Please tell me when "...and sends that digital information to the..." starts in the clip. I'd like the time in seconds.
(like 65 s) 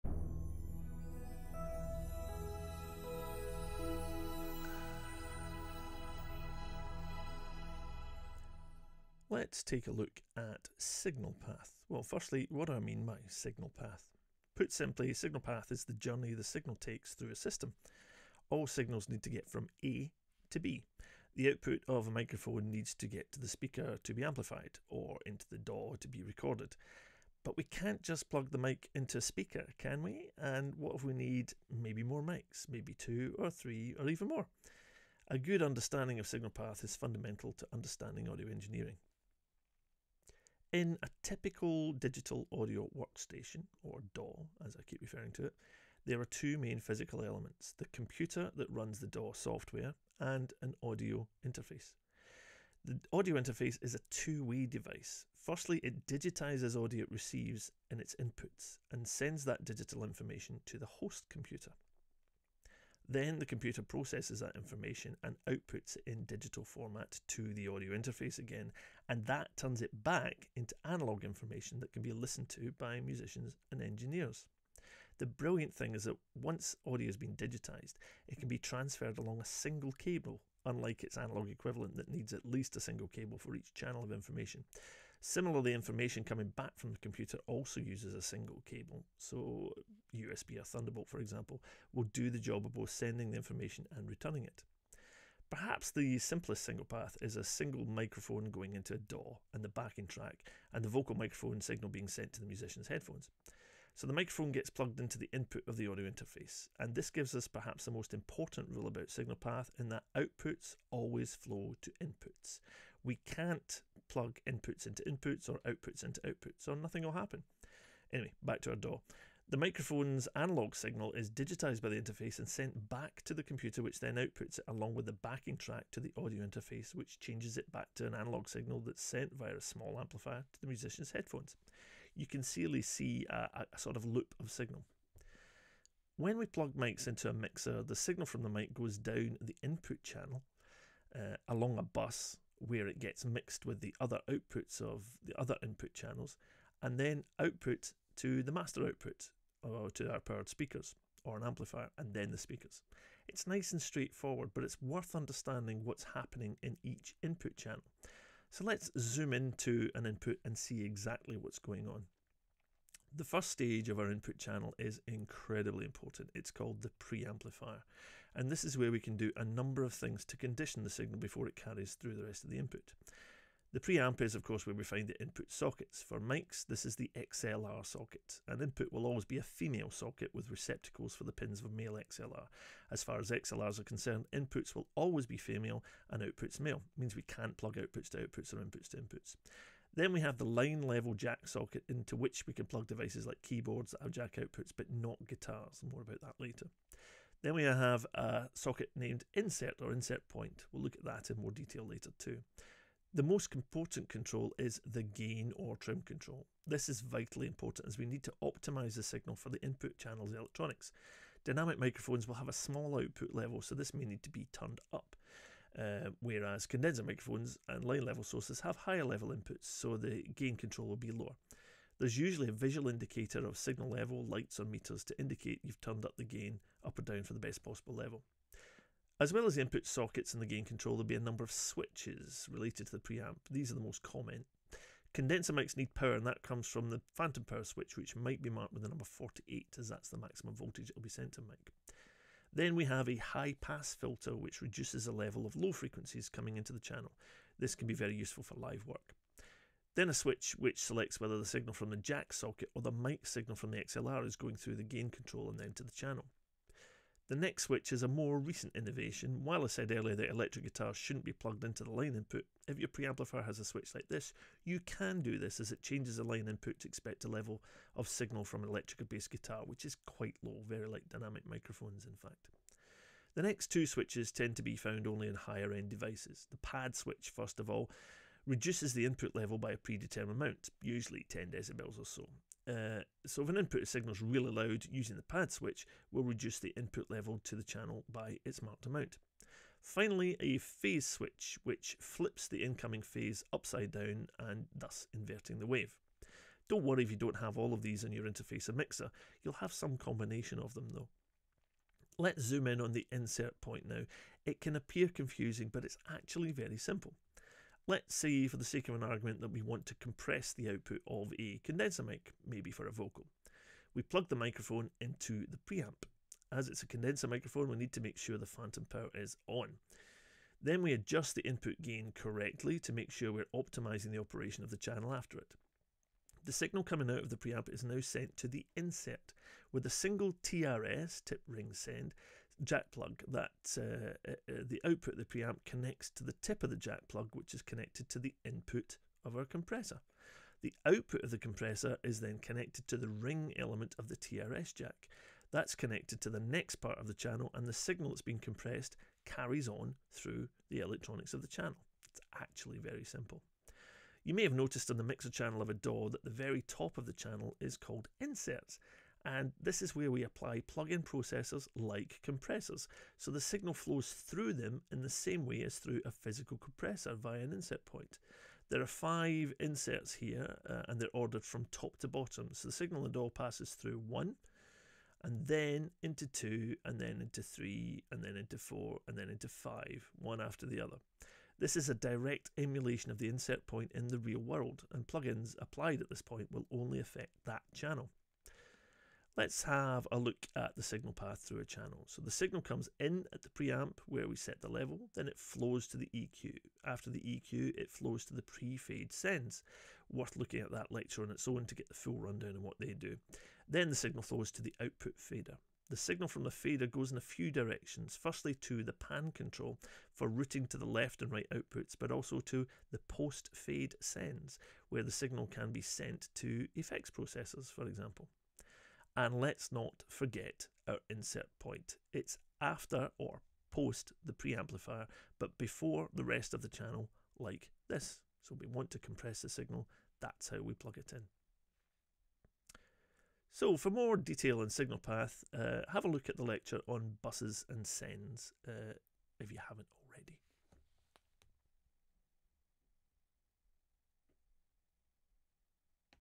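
58 s.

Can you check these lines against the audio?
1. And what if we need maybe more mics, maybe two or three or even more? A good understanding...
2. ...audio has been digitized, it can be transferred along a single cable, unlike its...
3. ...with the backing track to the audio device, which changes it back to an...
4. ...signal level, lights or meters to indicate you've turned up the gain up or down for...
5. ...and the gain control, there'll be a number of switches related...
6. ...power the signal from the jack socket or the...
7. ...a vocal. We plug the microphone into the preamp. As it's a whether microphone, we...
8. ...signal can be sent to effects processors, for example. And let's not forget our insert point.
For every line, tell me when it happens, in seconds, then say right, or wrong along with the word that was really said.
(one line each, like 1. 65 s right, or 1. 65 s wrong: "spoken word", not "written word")
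1. 30 s right
2. 76 s right
3. 124 s wrong: "interface", not "device"
4. 223 s right
5. 230 s right
6. 251 s wrong: "whether", not "power"
7. 312 s wrong: "condenser", not "whether"
8. 415 s right.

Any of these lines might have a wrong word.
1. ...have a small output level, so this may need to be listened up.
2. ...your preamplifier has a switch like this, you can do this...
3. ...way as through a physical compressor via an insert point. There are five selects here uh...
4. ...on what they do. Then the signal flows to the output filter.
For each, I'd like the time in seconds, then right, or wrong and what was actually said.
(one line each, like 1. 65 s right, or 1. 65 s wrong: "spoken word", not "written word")
1. 212 s wrong: "turned", not "listened"
2. 262 s right
3. 365 s wrong: "inserts", not "selects"
4. 402 s wrong: "fader", not "filter".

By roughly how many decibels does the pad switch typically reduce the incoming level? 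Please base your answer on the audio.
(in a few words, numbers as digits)
10 decibels.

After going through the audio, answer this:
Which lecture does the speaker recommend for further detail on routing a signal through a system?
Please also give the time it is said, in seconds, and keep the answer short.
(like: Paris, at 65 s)
Buses and sends, at 437 s.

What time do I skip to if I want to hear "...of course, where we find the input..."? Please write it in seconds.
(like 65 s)
174 s.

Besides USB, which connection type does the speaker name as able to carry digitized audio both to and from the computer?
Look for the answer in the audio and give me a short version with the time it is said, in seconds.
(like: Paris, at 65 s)
Thunderbolt, at 90 s.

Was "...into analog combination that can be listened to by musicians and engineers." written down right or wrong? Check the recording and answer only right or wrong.
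wrong.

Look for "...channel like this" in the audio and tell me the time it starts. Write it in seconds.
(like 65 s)
426 s.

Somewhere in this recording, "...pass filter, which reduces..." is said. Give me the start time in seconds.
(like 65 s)
243 s.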